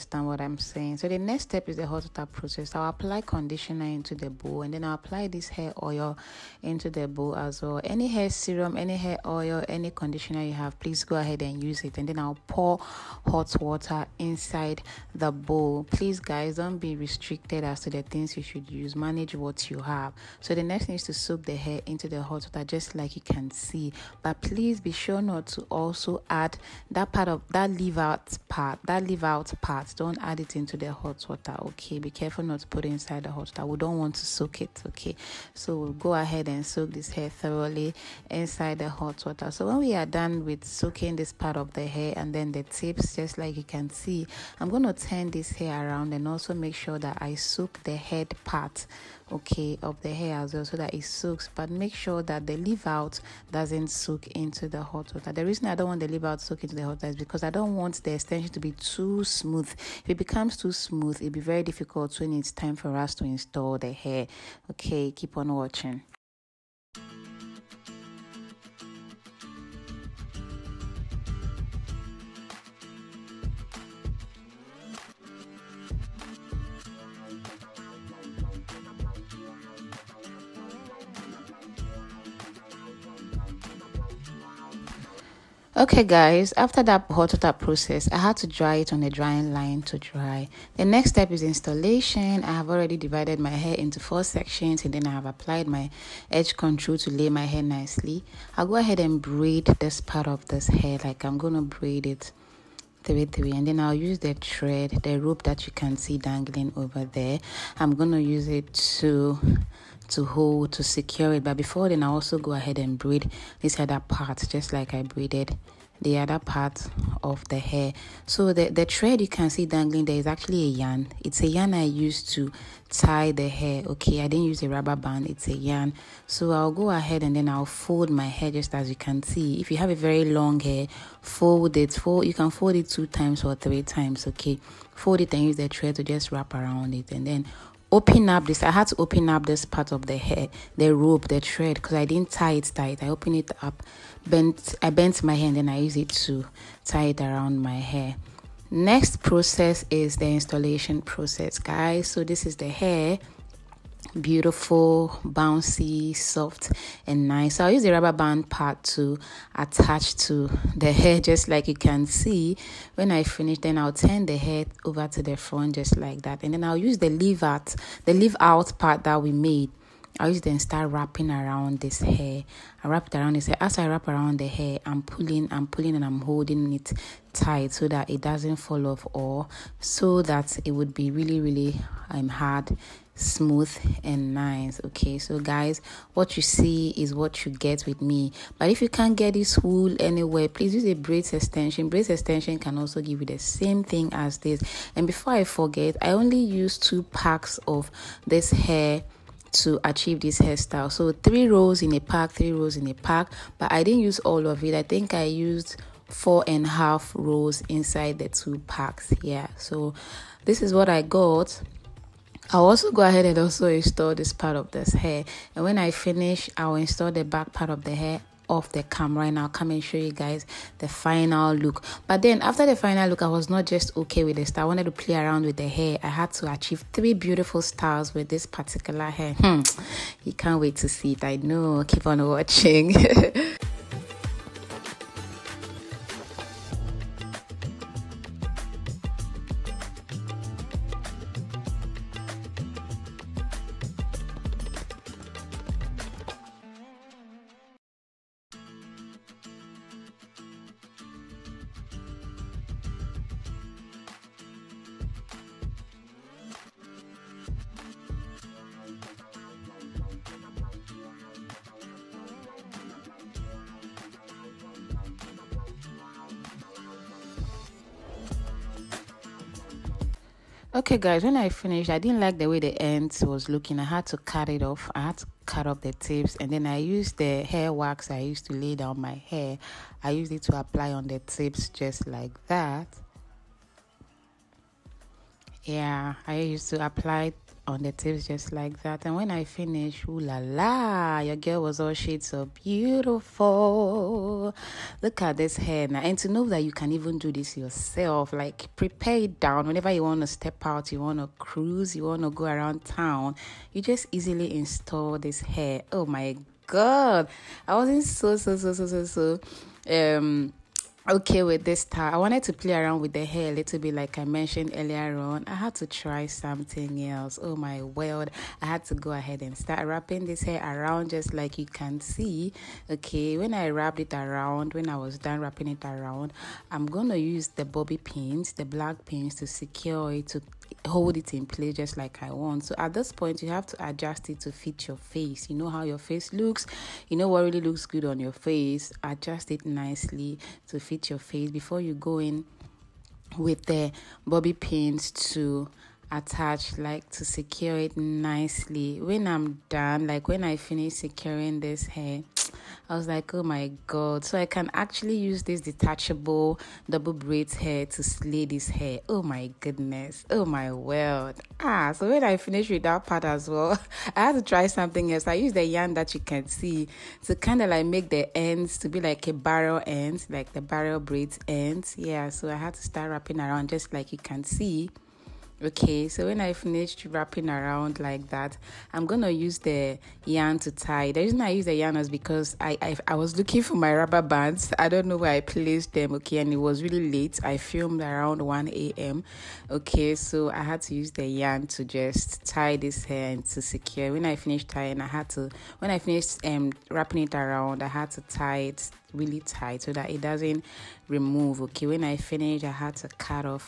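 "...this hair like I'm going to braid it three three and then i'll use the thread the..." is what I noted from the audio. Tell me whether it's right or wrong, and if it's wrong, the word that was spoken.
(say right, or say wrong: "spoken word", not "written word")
right.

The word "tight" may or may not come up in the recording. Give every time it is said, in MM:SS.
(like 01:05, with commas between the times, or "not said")
02:22, 02:57, 06:39.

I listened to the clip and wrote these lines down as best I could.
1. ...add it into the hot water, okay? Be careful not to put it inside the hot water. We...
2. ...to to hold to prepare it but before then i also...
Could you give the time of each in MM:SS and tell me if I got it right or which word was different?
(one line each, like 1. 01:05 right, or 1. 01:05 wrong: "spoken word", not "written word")
1. 00:30 right
2. 01:48 wrong: "secure", not "prepare".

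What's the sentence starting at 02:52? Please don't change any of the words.
I wrap it around this hair.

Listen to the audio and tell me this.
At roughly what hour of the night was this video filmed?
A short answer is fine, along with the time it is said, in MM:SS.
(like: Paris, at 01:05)
1 a.m., at 06:28.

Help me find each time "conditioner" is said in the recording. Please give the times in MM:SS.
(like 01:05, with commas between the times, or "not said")
00:03, 00:09.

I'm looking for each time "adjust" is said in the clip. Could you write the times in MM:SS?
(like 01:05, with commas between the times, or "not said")
05:33, 05:39.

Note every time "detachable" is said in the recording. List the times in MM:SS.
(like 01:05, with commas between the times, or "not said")
05:55.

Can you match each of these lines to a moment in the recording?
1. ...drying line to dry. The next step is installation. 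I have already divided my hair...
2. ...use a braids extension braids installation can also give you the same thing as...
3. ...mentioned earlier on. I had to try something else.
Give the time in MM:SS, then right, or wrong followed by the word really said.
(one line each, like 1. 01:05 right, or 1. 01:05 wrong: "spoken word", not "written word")
1. 01:29 right
2. 03:10 wrong: "extension", not "installation"
3. 05:14 right.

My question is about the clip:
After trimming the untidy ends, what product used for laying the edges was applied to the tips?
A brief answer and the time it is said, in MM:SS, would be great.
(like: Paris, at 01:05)
hair wax, at 04:37.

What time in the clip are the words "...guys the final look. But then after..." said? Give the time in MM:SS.
03:40.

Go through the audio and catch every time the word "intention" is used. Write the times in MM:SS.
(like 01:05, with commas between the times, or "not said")
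00:58.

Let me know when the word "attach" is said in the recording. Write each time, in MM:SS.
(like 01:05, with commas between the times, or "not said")
02:39, 05:46.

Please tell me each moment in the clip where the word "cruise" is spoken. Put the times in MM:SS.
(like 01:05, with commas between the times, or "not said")
05:01.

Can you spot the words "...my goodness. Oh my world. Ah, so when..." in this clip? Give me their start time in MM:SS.
05:59.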